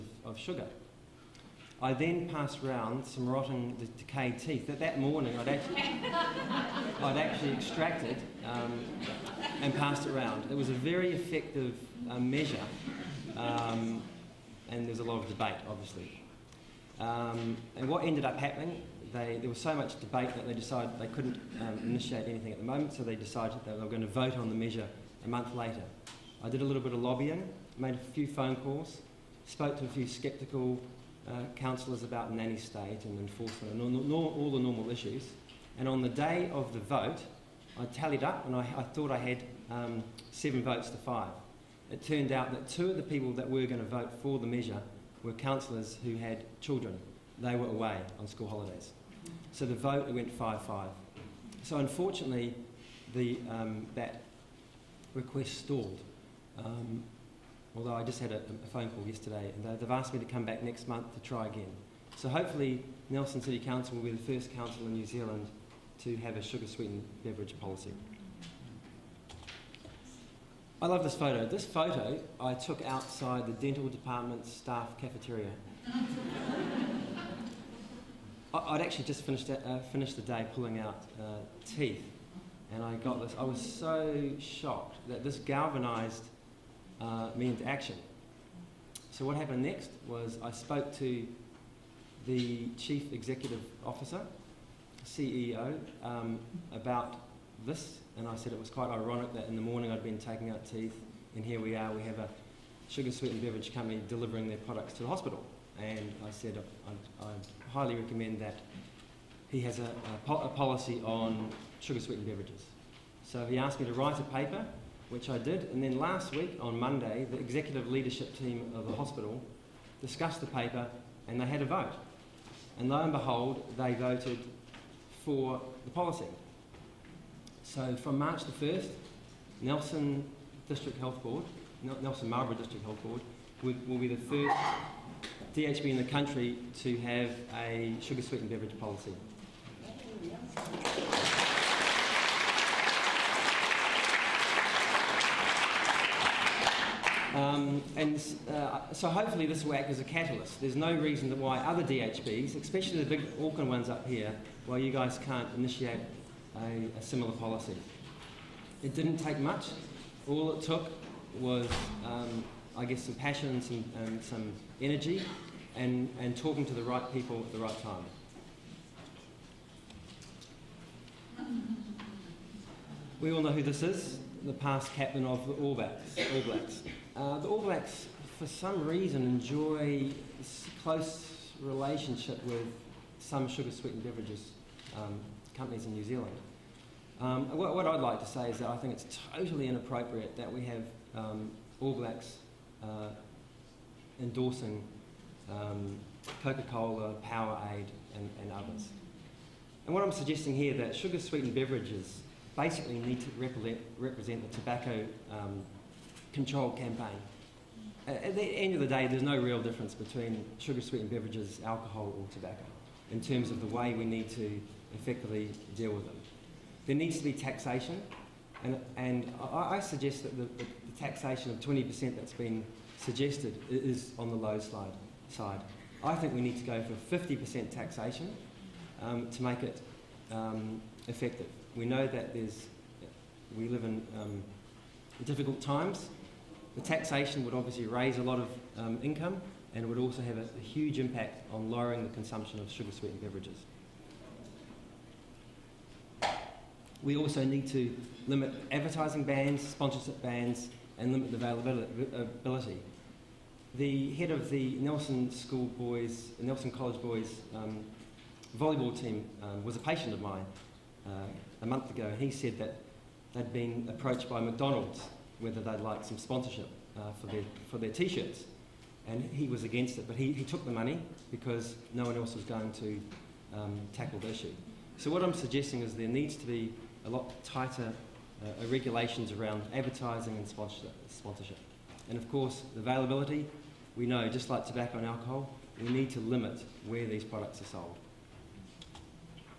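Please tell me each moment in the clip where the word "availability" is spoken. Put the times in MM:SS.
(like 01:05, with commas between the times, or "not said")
04:11, 04:42.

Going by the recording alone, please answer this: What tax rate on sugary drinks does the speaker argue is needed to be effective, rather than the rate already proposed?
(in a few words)
50%.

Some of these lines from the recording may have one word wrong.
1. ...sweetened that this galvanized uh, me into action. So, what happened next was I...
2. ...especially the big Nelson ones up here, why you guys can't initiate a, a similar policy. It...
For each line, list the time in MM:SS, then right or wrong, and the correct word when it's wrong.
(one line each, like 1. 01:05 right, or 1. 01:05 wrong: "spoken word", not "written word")
1. 01:24 wrong: "shocked", not "sweetened"
2. 02:32 wrong: "Auckland", not "Nelson".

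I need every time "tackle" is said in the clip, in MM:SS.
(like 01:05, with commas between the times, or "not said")
04:33.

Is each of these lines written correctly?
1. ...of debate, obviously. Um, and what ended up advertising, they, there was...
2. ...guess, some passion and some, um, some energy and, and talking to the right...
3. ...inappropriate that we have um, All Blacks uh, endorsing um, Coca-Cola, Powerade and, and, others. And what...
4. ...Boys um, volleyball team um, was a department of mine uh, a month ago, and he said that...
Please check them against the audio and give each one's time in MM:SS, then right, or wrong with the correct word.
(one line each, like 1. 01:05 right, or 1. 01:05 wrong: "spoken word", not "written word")
1. 00:15 wrong: "happening", not "advertising"
2. 02:42 right
3. 03:09 right
4. 04:17 wrong: "patient", not "department".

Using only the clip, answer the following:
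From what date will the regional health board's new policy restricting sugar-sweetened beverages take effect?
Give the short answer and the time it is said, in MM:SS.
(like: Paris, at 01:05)
March 1, at 02:08.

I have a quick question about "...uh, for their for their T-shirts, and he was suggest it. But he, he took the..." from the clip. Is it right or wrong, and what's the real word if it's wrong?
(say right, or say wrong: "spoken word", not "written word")
wrong: "against", not "suggest".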